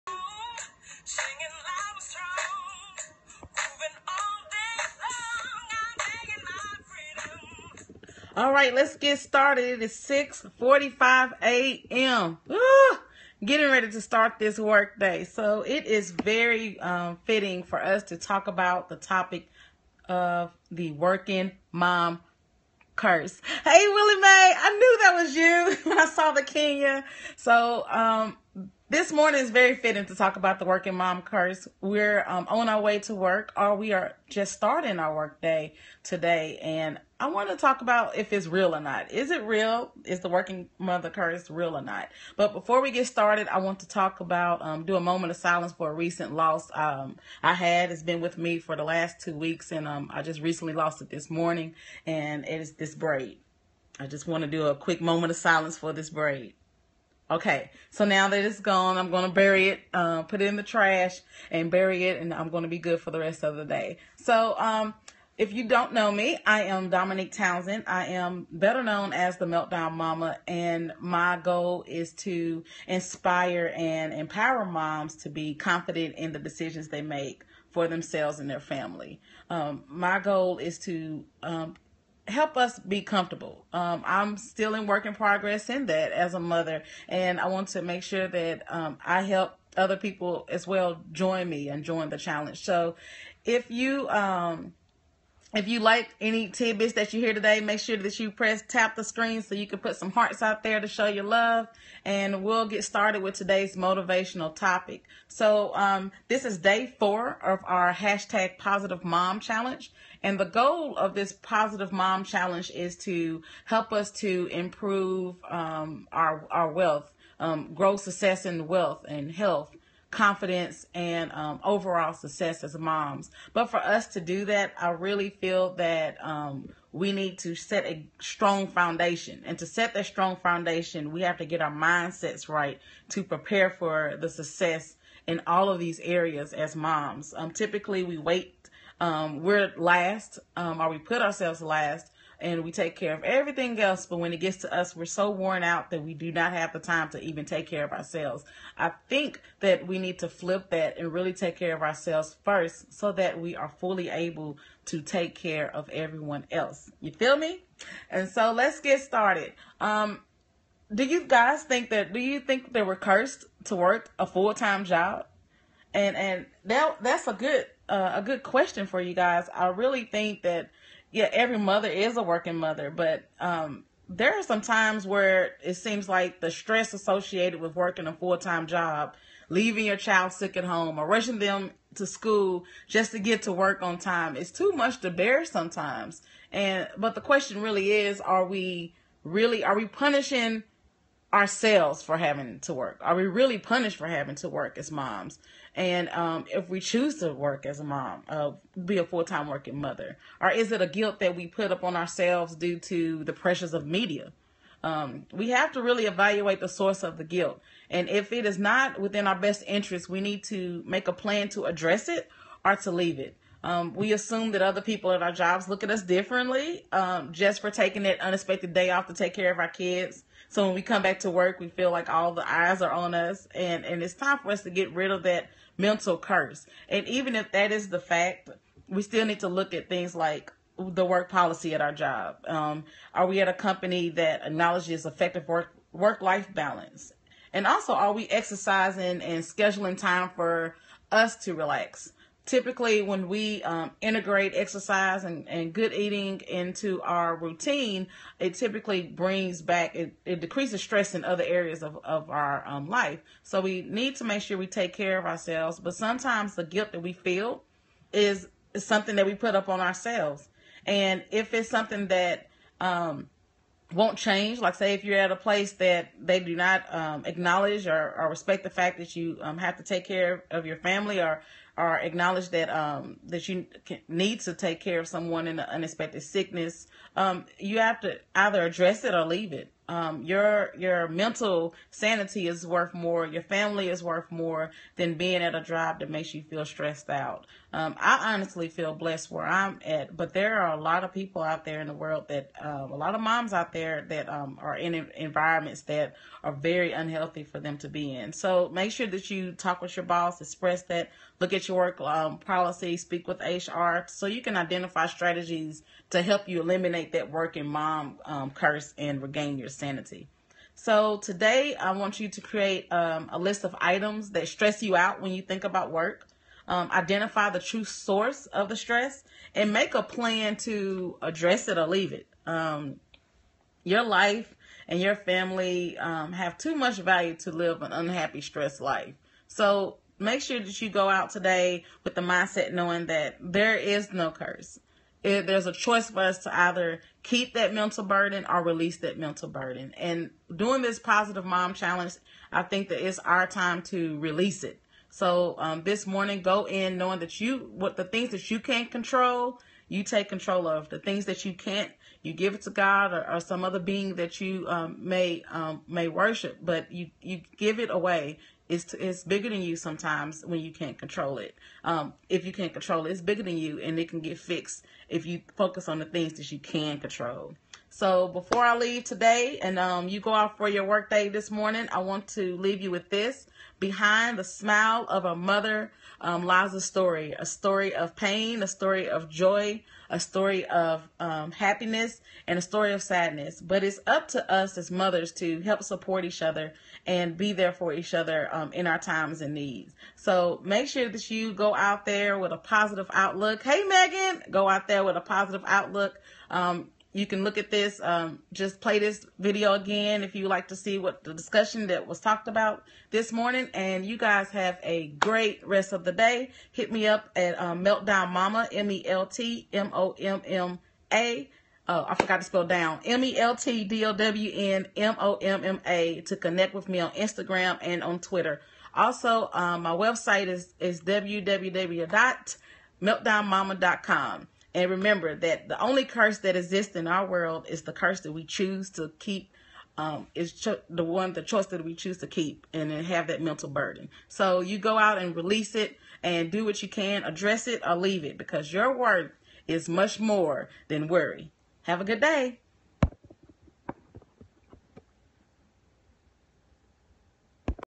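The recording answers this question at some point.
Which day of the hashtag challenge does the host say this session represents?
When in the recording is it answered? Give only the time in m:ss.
1:46.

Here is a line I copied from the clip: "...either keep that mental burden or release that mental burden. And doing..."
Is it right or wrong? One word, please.
right.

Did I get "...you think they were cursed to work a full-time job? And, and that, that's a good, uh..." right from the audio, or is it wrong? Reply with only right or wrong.
right.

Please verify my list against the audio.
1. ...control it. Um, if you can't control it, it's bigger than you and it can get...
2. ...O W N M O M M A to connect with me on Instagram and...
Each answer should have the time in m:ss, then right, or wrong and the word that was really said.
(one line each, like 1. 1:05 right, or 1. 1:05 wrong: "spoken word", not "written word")
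1. 6:00 right
2. 6:54 right.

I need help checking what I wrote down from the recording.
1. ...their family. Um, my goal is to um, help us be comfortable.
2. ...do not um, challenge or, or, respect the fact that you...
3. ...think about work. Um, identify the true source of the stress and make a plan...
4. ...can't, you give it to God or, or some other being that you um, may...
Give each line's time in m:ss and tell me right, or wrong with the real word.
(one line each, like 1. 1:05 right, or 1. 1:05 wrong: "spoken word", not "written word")
1. 1:18 right
2. 4:26 wrong: "acknowledge", not "challenge"
3. 5:15 right
4. 5:51 right.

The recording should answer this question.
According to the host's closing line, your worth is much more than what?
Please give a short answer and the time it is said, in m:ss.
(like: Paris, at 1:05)
worry, at 7:21.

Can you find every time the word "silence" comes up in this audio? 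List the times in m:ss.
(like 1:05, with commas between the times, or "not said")
0:45, 0:55.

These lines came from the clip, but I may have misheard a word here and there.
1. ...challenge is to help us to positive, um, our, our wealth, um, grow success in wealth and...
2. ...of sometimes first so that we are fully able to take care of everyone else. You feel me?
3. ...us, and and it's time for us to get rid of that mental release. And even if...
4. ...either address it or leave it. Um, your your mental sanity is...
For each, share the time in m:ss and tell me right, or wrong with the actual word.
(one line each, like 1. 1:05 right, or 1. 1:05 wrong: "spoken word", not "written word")
1. 1:52 wrong: "improve", not "positive"
2. 2:31 wrong: "ourselves", not "sometimes"
3. 3:43 wrong: "curse", not "release"
4. 4:38 right.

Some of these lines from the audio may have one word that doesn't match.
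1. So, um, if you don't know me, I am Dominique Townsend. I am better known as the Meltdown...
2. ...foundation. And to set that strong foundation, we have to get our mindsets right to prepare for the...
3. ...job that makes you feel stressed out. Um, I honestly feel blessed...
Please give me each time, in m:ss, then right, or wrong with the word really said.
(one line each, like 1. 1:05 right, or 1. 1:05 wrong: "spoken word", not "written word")
1. 1:04 right
2. 2:08 right
3. 4:45 right.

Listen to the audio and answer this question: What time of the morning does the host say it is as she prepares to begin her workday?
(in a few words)
6:45 a.m.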